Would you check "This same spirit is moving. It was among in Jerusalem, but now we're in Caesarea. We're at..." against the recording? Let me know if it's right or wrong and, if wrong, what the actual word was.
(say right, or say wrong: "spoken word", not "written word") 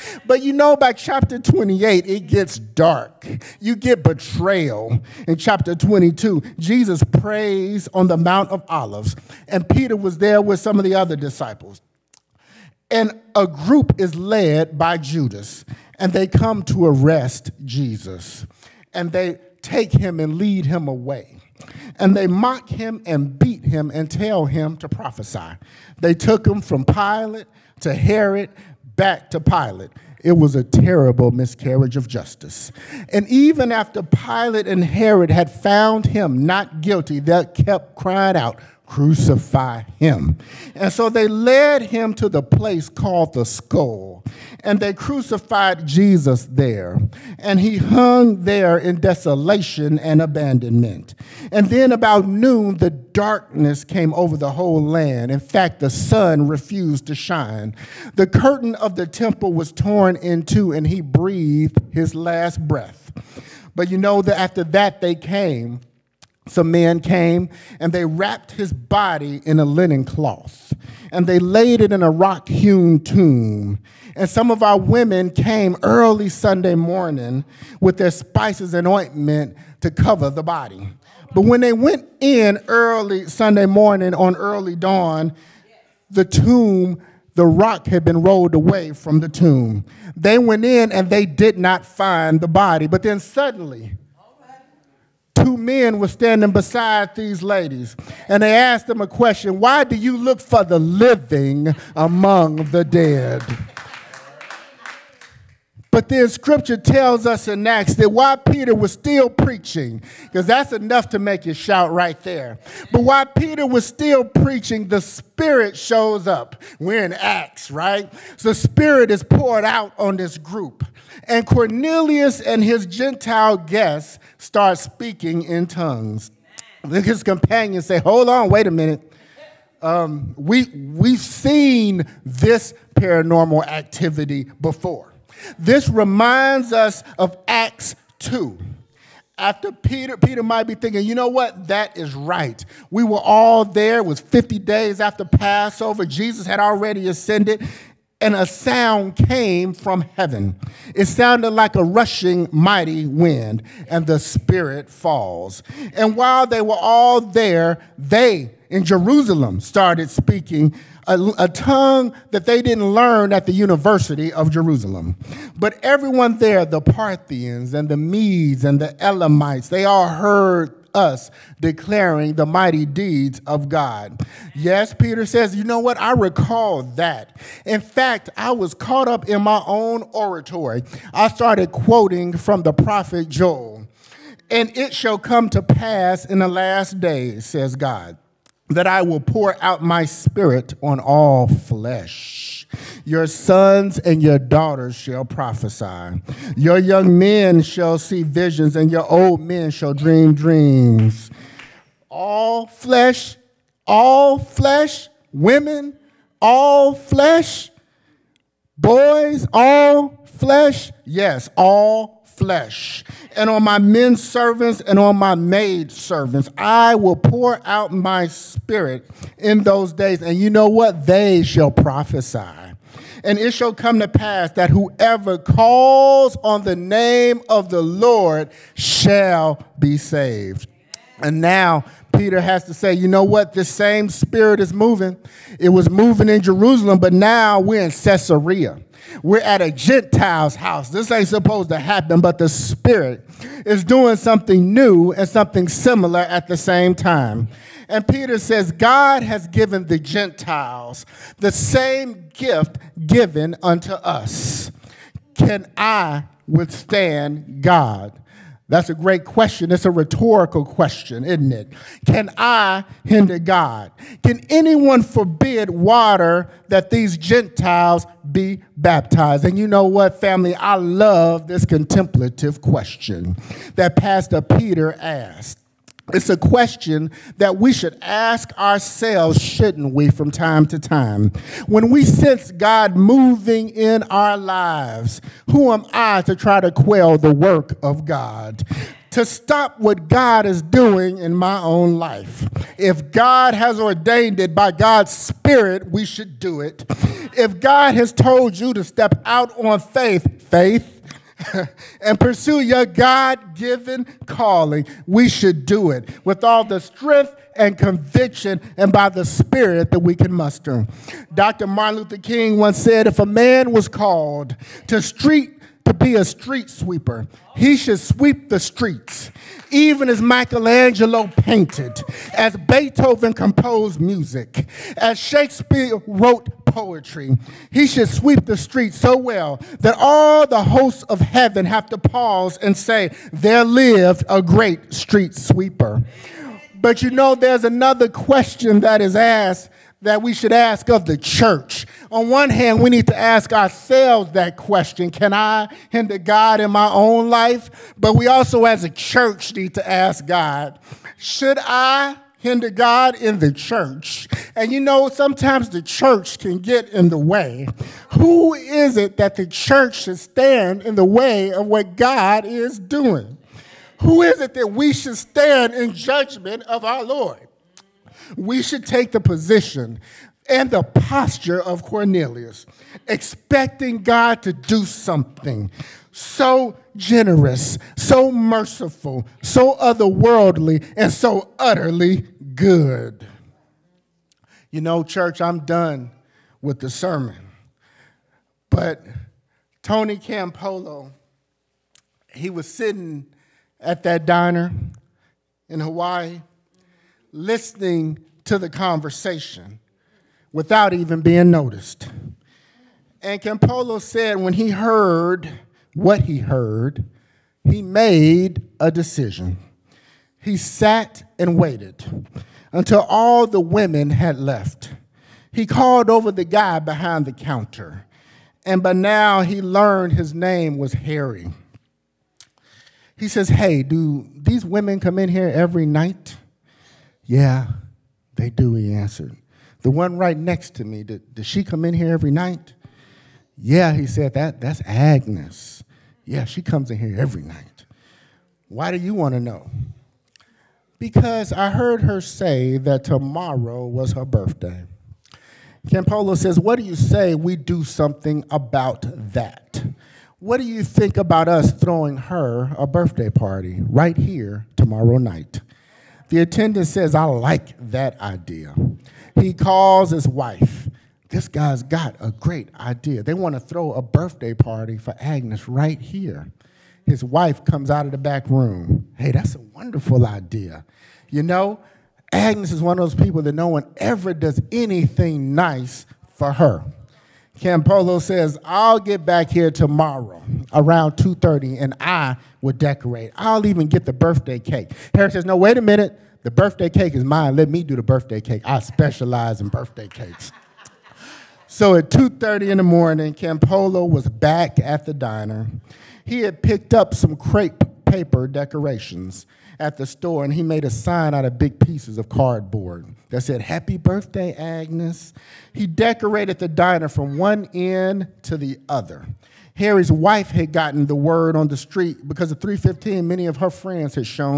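wrong: "moving", not "among".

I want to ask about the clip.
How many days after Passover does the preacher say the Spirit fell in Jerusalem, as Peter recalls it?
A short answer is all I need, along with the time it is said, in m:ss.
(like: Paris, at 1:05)
50, at 2:24.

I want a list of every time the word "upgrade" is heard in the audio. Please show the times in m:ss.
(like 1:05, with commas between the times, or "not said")
not said.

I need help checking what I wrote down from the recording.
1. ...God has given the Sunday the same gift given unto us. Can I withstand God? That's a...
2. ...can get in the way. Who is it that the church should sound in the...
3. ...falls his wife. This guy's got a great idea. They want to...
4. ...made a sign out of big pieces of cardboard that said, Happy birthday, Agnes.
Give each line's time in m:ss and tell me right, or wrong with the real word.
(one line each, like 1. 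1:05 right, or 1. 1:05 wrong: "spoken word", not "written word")
1. 4:08 wrong: "Gentiles", not "Sunday"
2. 5:56 wrong: "stand", not "sound"
3. 7:39 wrong: "calls", not "falls"
4. 8:20 right.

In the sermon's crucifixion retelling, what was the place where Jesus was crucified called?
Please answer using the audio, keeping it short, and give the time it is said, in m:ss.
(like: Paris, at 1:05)
The skull, at 0:43.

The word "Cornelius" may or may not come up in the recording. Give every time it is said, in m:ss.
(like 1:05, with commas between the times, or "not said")
2:01, 6:11.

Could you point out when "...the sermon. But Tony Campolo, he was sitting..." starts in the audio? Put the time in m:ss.
6:26.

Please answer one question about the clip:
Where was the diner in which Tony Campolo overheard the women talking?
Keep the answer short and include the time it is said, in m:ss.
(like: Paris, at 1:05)
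Hawaii, at 6:35.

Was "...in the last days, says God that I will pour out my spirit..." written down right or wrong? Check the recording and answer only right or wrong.
right.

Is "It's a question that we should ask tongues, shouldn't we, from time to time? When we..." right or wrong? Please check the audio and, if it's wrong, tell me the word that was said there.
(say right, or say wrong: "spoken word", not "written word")
wrong: "ourselves", not "tongues".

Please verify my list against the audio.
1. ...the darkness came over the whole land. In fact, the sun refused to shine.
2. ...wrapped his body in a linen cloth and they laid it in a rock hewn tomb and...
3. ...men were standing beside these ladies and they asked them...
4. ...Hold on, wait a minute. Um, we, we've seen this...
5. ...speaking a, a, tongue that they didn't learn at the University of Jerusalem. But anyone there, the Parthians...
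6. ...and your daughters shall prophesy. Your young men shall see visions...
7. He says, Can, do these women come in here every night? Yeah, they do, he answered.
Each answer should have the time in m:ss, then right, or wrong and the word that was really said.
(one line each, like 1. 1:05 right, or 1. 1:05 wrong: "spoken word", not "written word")
1. 0:52 right
2. 1:08 right
3. 1:35 right
4. 2:08 right
5. 2:40 wrong: "everyone", not "anyone"
6. 3:13 right
7. 7:03 wrong: "Hey", not "Can".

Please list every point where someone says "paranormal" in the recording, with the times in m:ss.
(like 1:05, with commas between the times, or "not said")
2:12.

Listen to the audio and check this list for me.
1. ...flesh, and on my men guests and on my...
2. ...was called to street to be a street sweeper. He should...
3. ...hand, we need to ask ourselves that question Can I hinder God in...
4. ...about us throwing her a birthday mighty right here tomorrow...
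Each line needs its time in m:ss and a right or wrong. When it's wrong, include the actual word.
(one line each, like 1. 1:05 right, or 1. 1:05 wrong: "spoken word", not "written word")
1. 3:32 wrong: "servants", not "guests"
2. 5:13 right
3. 5:42 right
4. 7:31 wrong: "party", not "mighty".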